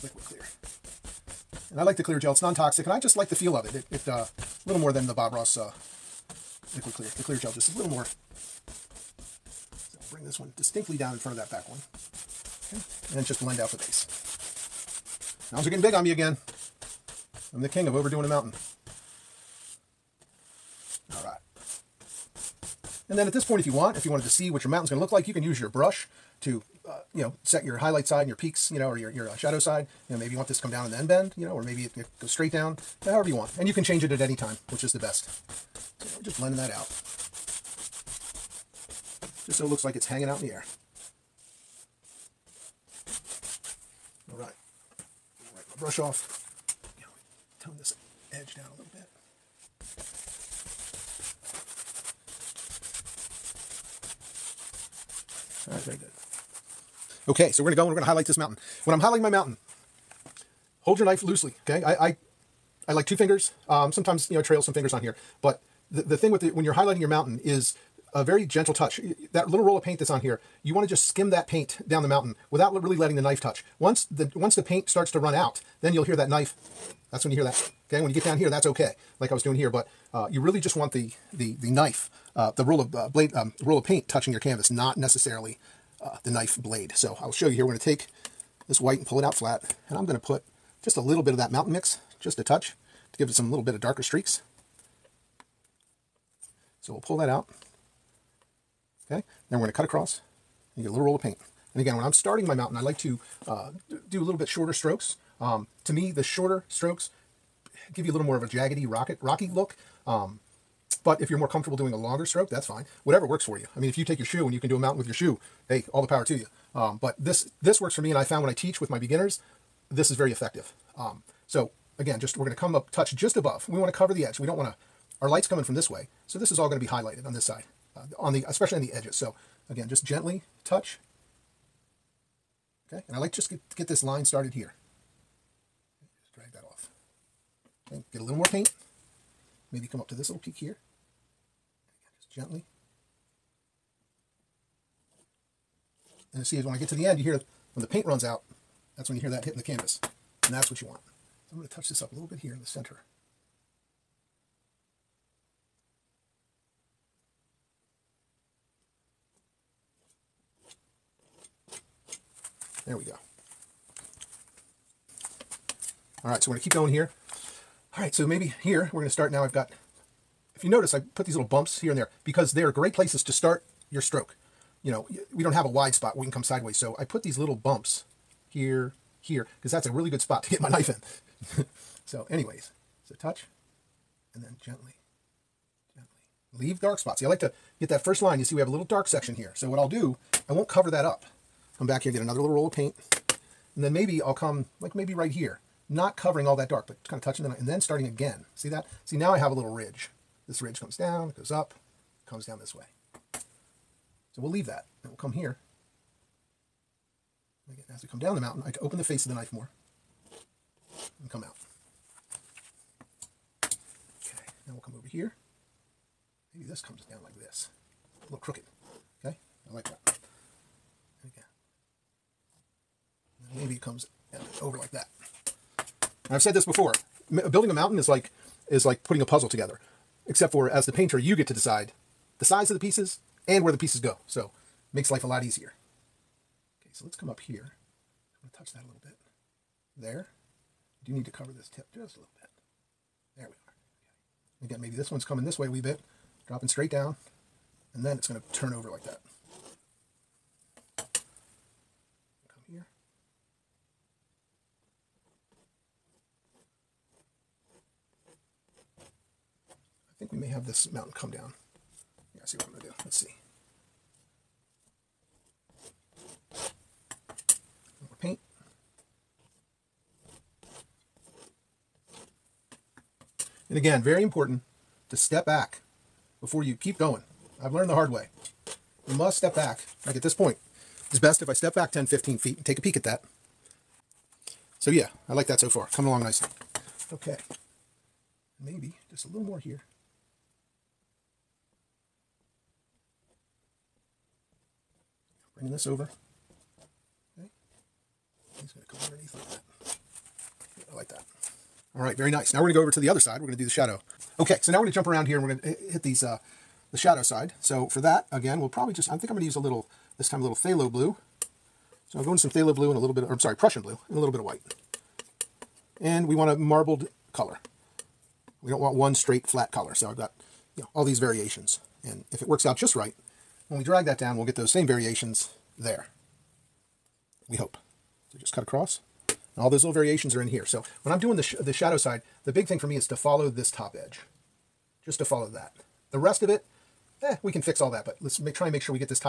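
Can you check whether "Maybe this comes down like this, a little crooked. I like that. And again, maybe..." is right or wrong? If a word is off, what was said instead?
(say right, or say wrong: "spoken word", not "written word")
right.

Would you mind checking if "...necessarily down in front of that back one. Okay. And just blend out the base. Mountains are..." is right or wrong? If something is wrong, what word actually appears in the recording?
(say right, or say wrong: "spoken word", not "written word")
wrong: "distinctly", not "necessarily".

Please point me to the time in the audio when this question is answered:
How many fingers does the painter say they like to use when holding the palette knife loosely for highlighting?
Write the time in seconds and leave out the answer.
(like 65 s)
63 s.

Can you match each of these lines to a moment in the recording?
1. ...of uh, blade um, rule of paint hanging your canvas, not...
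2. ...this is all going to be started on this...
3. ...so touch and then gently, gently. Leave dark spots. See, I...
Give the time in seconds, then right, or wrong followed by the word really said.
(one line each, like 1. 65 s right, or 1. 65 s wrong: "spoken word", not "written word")
1. 82 s wrong: "touching", not "hanging"
2. 126 s wrong: "highlighted", not "started"
3. 183 s right.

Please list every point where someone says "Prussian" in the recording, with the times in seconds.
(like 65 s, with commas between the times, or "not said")
313 s.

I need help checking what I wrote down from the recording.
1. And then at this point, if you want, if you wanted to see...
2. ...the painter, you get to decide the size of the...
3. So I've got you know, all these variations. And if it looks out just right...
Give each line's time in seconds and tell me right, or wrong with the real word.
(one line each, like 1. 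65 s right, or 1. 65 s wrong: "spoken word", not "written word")
1. 23 s right
2. 230 s right
3. 319 s wrong: "works", not "looks".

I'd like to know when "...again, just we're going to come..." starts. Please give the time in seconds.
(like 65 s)
121 s.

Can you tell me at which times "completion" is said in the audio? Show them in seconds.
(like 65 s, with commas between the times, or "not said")
not said.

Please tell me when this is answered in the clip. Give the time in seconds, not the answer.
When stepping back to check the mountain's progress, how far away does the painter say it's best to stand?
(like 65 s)
281 s.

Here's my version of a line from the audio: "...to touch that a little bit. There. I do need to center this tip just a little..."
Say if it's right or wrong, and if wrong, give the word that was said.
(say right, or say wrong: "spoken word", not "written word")
wrong: "cover", not "center".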